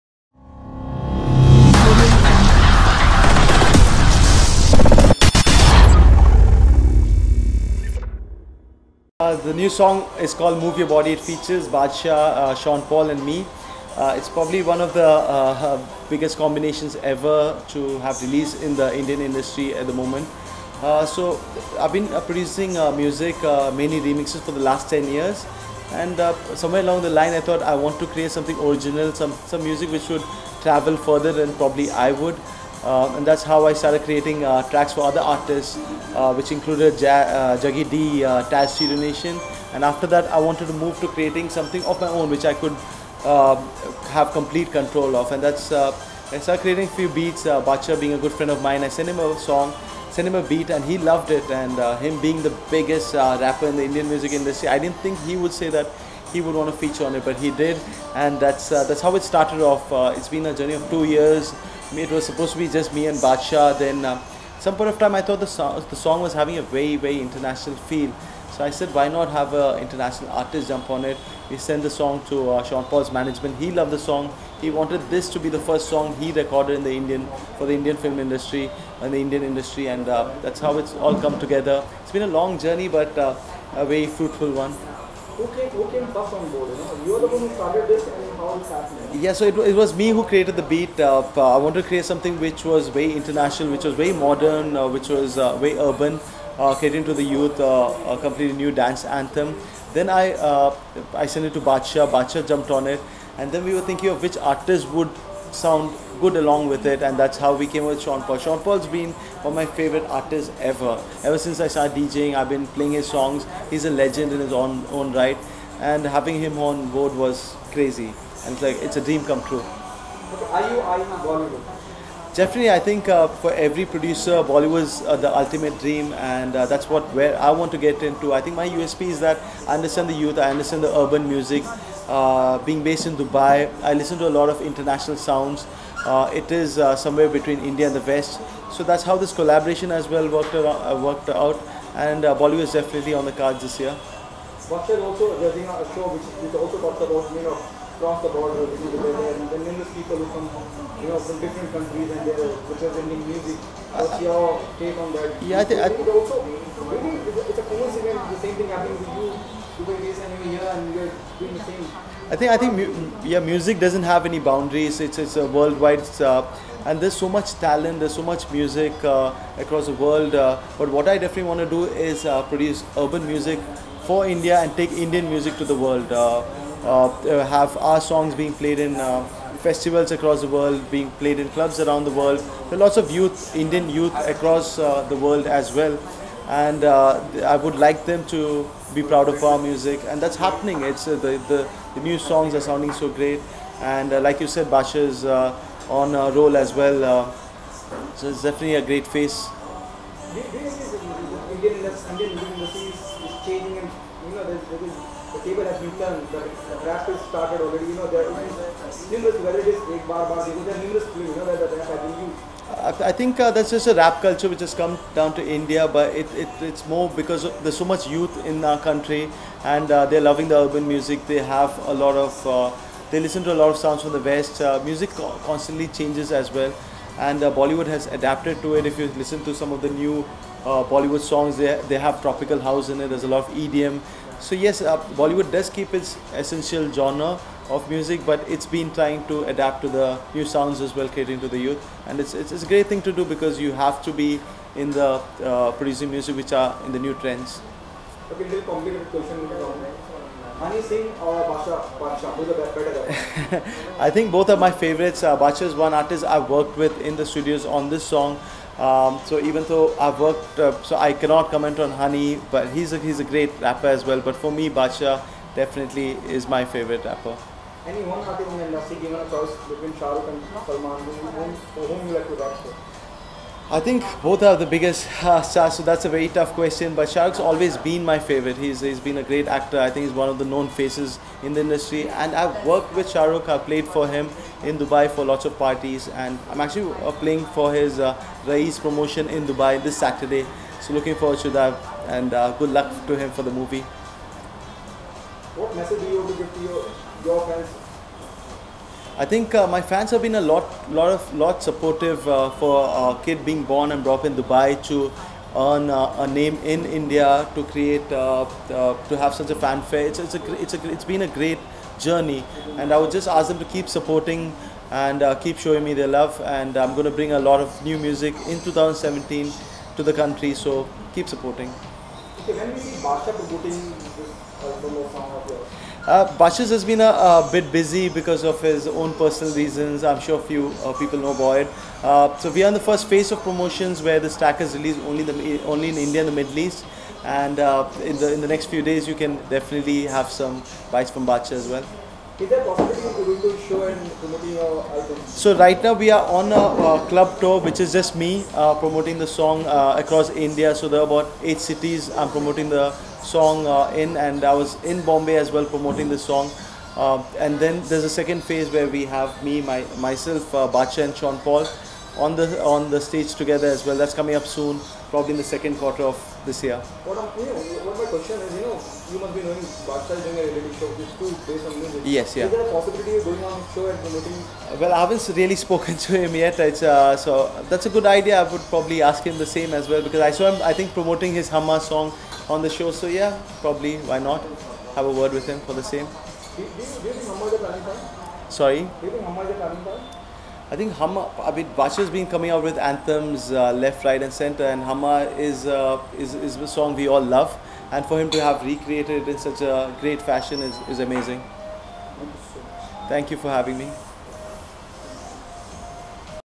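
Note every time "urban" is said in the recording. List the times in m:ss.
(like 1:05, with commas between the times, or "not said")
1:35, 2:10, 2:52, 3:40.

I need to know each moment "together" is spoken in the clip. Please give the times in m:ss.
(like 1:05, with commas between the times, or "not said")
1:21, 6:03.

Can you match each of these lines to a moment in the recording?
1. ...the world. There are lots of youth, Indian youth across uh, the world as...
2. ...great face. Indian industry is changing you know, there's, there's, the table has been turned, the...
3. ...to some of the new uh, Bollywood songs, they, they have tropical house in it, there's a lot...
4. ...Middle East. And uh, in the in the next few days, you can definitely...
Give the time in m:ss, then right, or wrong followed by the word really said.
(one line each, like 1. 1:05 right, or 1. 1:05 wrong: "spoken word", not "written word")
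1. 3:02 right
2. 3:18 right
3. 3:49 right
4. 5:36 right.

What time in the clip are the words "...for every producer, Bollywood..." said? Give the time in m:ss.
2:03.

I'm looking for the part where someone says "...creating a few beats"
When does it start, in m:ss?
0:46.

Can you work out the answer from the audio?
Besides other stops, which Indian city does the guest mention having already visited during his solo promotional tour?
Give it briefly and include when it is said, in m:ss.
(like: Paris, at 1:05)
Bombay, at 5:55.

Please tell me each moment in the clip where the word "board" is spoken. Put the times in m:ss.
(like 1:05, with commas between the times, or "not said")
1:26, 1:56.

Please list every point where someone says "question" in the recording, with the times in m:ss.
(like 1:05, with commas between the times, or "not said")
4:09, 4:36, 6:08.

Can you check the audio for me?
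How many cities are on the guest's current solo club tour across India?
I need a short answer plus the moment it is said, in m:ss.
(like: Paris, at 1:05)
8, at 5:51.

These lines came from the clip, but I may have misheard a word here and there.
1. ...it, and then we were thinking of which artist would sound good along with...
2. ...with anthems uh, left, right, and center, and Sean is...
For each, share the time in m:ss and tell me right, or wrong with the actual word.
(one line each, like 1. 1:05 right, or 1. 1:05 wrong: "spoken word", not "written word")
1. 1:42 right
2. 6:32 wrong: "Humma", not "Sean".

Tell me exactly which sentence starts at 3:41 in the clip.
They have a lot of, uh, they listen to a lot of sounds from the West.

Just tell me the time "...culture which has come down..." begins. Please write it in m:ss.
3:34.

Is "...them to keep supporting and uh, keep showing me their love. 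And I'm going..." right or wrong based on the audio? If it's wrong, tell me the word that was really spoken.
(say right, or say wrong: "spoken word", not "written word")
right.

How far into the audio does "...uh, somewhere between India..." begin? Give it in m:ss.
2:16.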